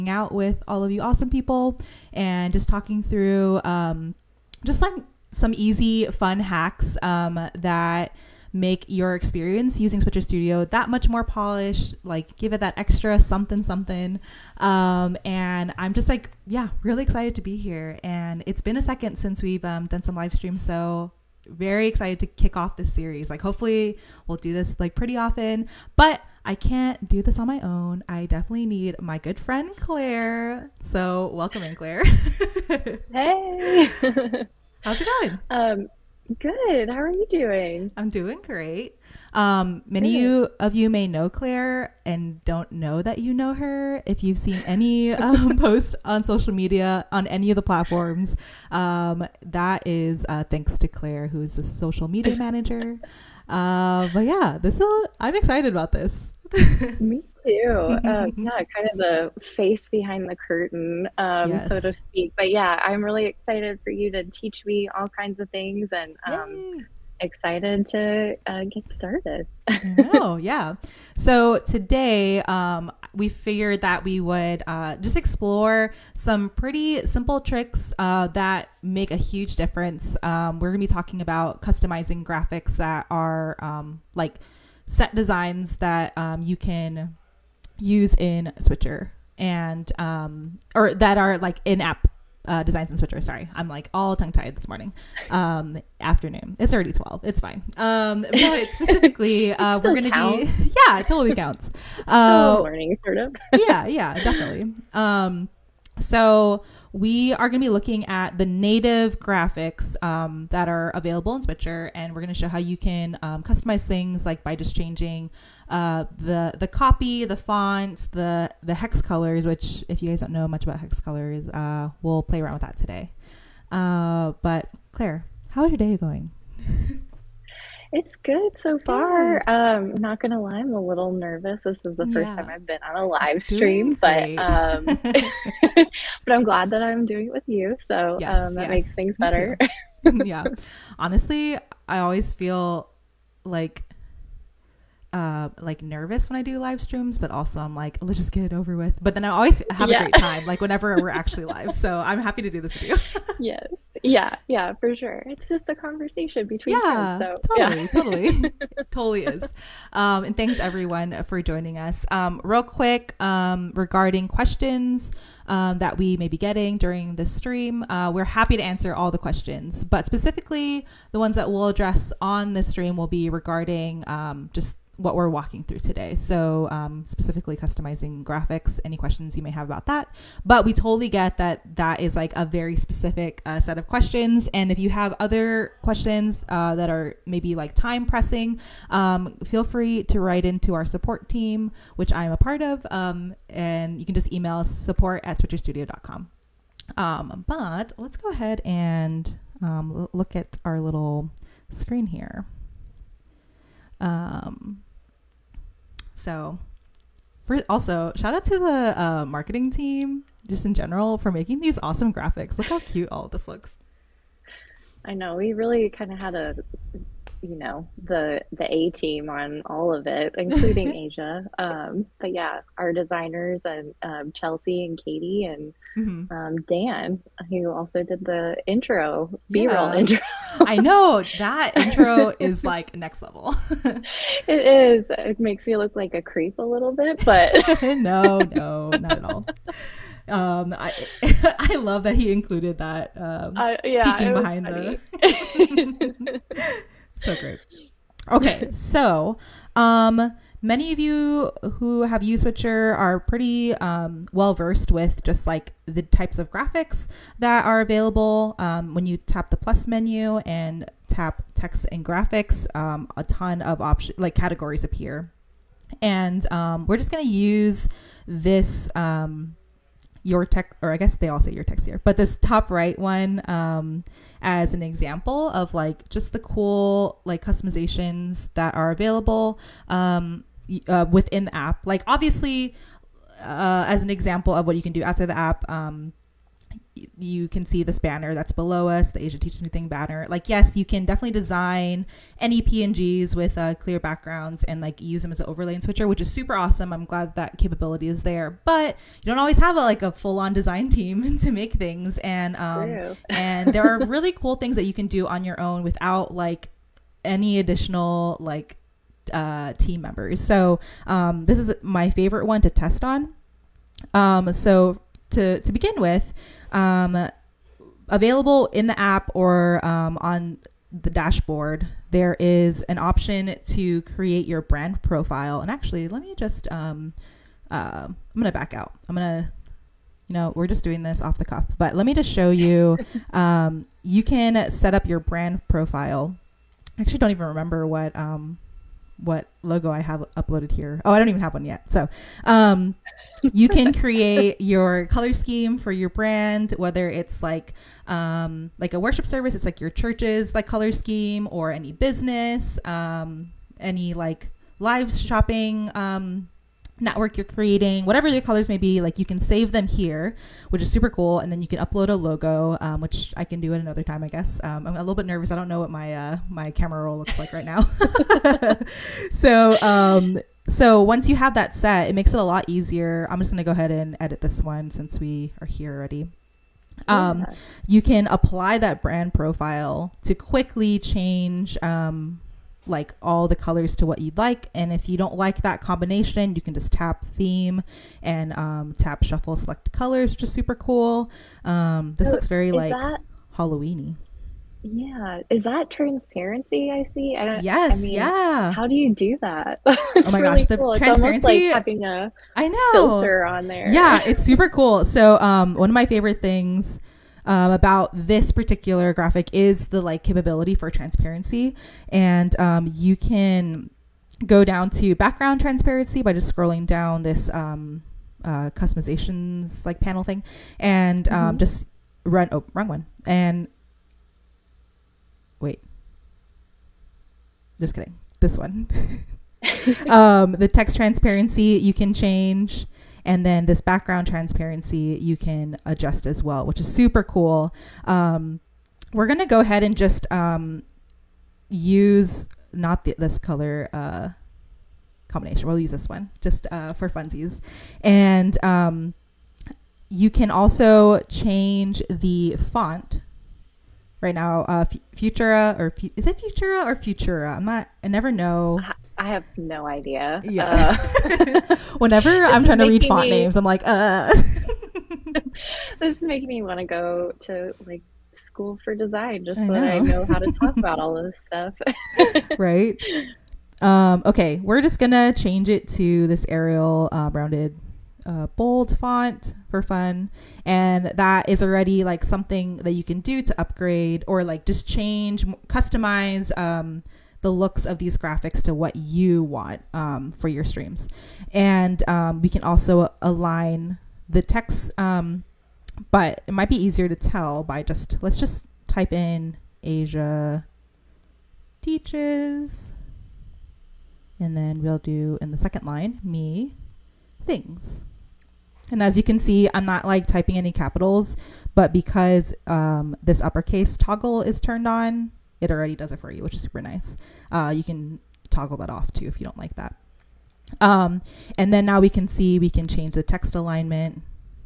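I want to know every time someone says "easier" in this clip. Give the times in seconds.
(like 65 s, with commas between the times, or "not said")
372 s, 496 s.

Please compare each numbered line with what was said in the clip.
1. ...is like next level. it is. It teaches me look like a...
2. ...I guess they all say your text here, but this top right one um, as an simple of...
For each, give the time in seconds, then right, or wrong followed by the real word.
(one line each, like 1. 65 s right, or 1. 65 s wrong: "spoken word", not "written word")
1. 232 s wrong: "makes", not "teaches"
2. 270 s wrong: "example", not "simple".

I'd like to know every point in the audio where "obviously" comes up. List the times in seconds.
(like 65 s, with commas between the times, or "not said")
282 s.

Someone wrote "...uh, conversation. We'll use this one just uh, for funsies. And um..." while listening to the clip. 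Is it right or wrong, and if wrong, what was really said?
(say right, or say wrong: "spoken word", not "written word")
wrong: "combination", not "conversation".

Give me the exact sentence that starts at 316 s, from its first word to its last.
Um, available in the app or um, on the dashboard, there is an option to create your brand profile.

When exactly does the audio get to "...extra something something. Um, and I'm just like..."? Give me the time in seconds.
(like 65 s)
12 s.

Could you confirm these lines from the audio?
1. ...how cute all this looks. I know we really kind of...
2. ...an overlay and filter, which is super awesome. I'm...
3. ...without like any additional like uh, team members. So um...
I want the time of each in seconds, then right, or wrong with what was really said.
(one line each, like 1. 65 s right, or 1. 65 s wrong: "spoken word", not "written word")
1. 212 s right
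2. 295 s wrong: "switcher", not "filter"
3. 305 s right.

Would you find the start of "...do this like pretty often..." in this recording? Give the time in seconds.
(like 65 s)
24 s.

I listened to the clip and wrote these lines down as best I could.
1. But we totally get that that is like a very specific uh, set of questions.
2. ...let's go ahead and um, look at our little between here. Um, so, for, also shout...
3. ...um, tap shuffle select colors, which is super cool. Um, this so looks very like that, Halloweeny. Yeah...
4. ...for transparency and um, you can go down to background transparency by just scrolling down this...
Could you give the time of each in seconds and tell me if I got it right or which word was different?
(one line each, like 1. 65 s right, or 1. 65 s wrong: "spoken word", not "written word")
1. 180 s right
2. 197 s wrong: "screen", not "between"
3. 388 s right
4. 410 s right.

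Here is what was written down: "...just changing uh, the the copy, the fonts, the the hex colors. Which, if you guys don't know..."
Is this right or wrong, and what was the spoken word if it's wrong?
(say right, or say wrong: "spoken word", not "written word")
right.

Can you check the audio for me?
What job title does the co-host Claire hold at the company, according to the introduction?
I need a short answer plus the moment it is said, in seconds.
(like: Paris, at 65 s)
Social media manager, at 51 s.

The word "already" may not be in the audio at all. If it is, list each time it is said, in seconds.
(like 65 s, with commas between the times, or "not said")
96 s, 375 s, 481 s, 515 s.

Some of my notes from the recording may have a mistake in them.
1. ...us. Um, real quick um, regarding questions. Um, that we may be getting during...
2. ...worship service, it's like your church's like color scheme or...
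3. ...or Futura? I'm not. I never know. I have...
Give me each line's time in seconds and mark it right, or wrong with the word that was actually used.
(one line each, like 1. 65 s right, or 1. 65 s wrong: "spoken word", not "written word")
1. 161 s right
2. 348 s right
3. 456 s right.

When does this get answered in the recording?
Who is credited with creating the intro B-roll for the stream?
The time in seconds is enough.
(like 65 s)
226 s.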